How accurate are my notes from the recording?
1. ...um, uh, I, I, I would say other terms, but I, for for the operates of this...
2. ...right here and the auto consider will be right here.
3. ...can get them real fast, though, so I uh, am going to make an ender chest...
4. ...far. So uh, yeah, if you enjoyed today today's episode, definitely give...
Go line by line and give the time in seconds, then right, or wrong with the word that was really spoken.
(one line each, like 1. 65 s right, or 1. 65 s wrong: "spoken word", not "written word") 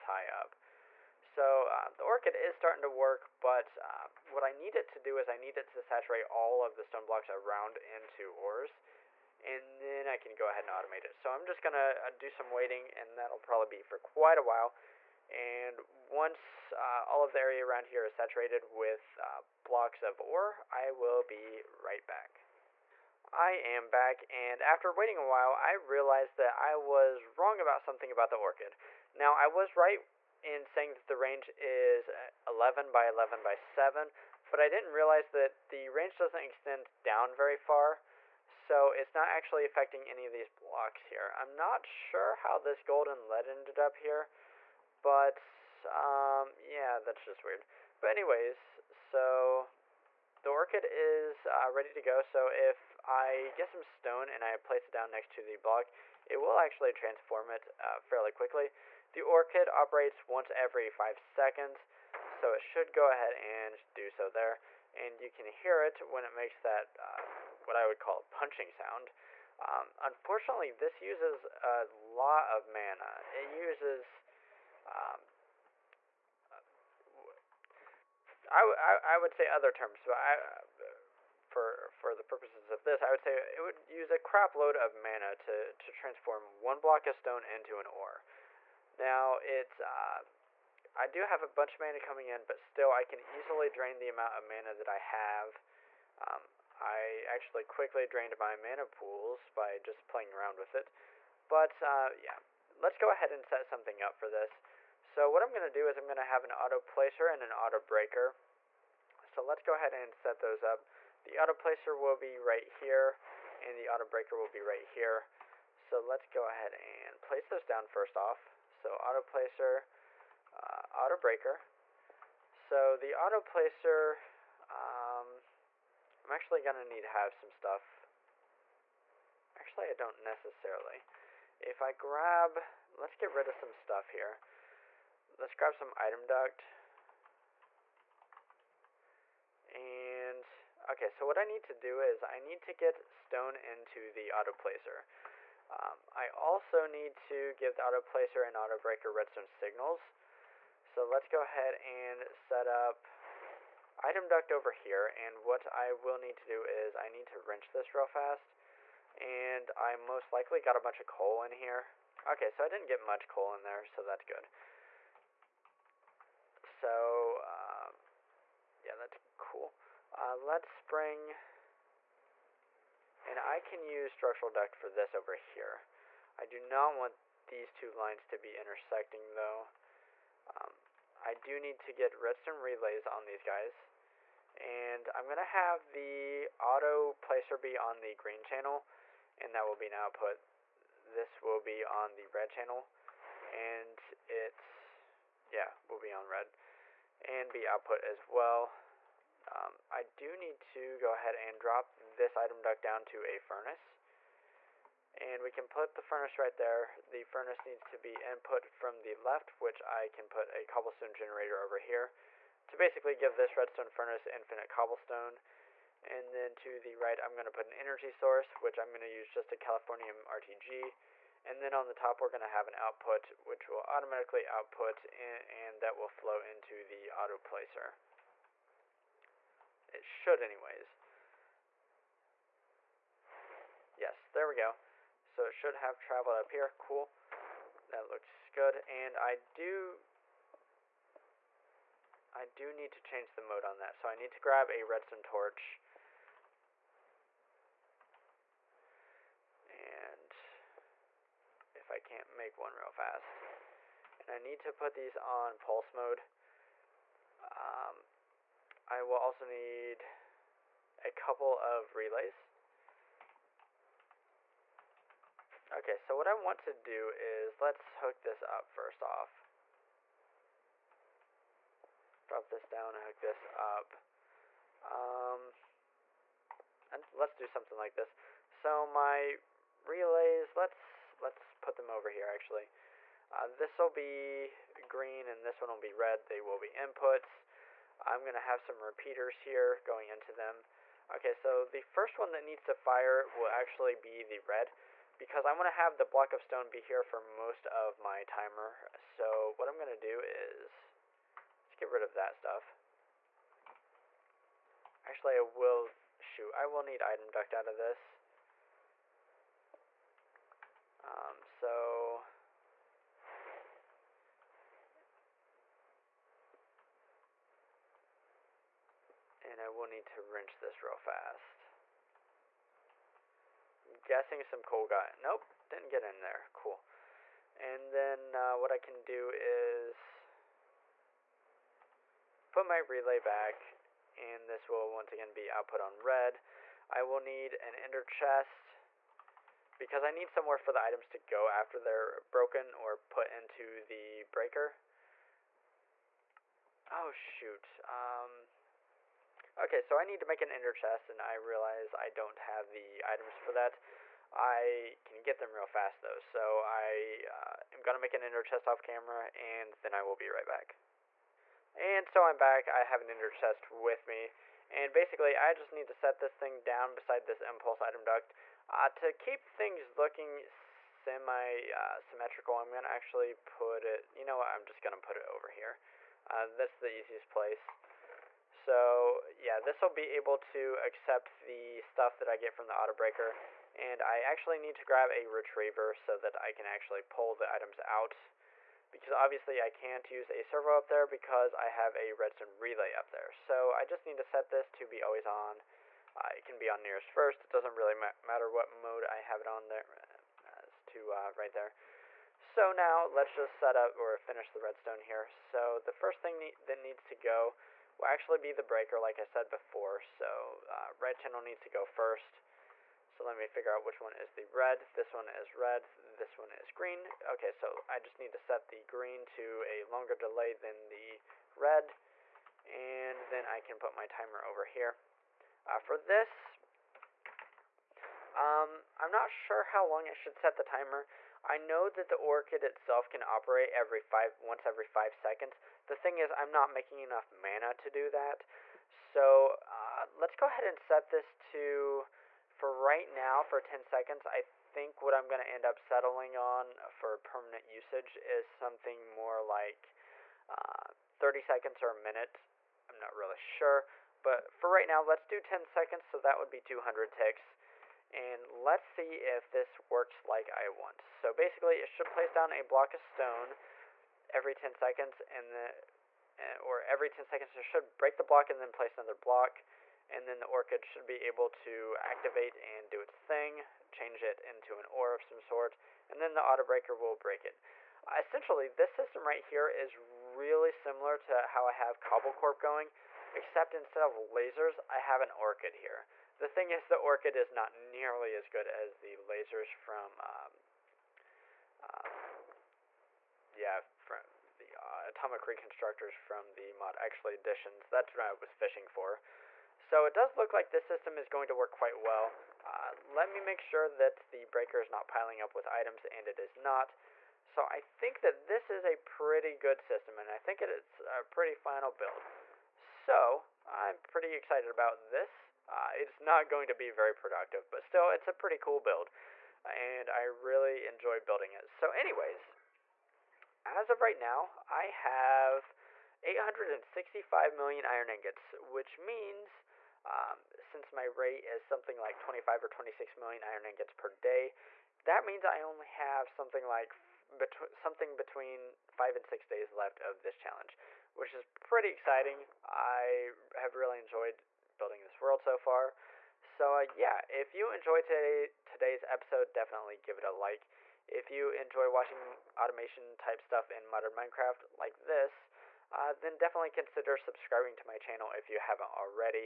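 1. 74 s wrong: "purposes", not "operates"
2. 112 s wrong: "breaker", not "consider"
3. 355 s right
4. 545 s right.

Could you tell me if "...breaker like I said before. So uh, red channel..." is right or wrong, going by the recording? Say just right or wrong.
right.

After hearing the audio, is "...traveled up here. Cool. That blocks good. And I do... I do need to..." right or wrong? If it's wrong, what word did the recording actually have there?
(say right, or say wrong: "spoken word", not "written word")
wrong: "looks", not "blocks".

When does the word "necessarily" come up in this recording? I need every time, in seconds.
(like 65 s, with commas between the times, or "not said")
130 s.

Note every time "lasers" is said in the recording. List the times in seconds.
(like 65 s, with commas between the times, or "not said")
484 s, 489 s.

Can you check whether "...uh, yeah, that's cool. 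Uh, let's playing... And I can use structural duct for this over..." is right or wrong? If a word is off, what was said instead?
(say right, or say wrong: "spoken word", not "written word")
wrong: "bring", not "playing".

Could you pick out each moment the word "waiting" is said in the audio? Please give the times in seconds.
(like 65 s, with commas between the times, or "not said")
12 s, 24 s.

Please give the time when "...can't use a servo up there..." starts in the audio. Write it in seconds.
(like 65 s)
389 s.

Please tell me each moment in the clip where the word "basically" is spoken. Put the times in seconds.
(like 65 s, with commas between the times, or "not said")
212 s, 364 s, 461 s.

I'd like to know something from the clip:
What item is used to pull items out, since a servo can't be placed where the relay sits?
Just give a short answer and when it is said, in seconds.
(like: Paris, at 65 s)
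Retriever, at 385 s.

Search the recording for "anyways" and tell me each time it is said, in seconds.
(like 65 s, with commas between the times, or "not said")
48 s, 230 s, 521 s.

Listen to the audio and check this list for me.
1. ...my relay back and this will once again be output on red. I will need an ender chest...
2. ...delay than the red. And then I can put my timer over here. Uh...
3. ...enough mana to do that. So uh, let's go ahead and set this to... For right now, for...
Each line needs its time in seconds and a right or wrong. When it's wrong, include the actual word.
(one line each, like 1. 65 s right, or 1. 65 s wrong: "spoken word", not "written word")
1. 332 s right
2. 420 s right
3. 436 s right.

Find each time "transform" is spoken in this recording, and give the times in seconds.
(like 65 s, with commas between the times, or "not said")
56 s, 85 s.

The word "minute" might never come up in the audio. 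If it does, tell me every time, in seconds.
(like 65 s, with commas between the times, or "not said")
451 s.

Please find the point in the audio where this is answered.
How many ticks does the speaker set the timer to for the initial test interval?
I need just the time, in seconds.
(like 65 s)
456 s.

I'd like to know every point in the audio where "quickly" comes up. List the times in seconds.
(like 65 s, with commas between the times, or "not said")
58 s, 97 s.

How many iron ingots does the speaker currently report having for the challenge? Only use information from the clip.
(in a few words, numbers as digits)
865 million.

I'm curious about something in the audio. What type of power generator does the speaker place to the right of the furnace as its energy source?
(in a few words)
Californium RTG.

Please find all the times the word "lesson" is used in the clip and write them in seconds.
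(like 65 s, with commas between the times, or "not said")
not said.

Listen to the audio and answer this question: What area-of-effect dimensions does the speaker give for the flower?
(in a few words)
11 by 11 by 7.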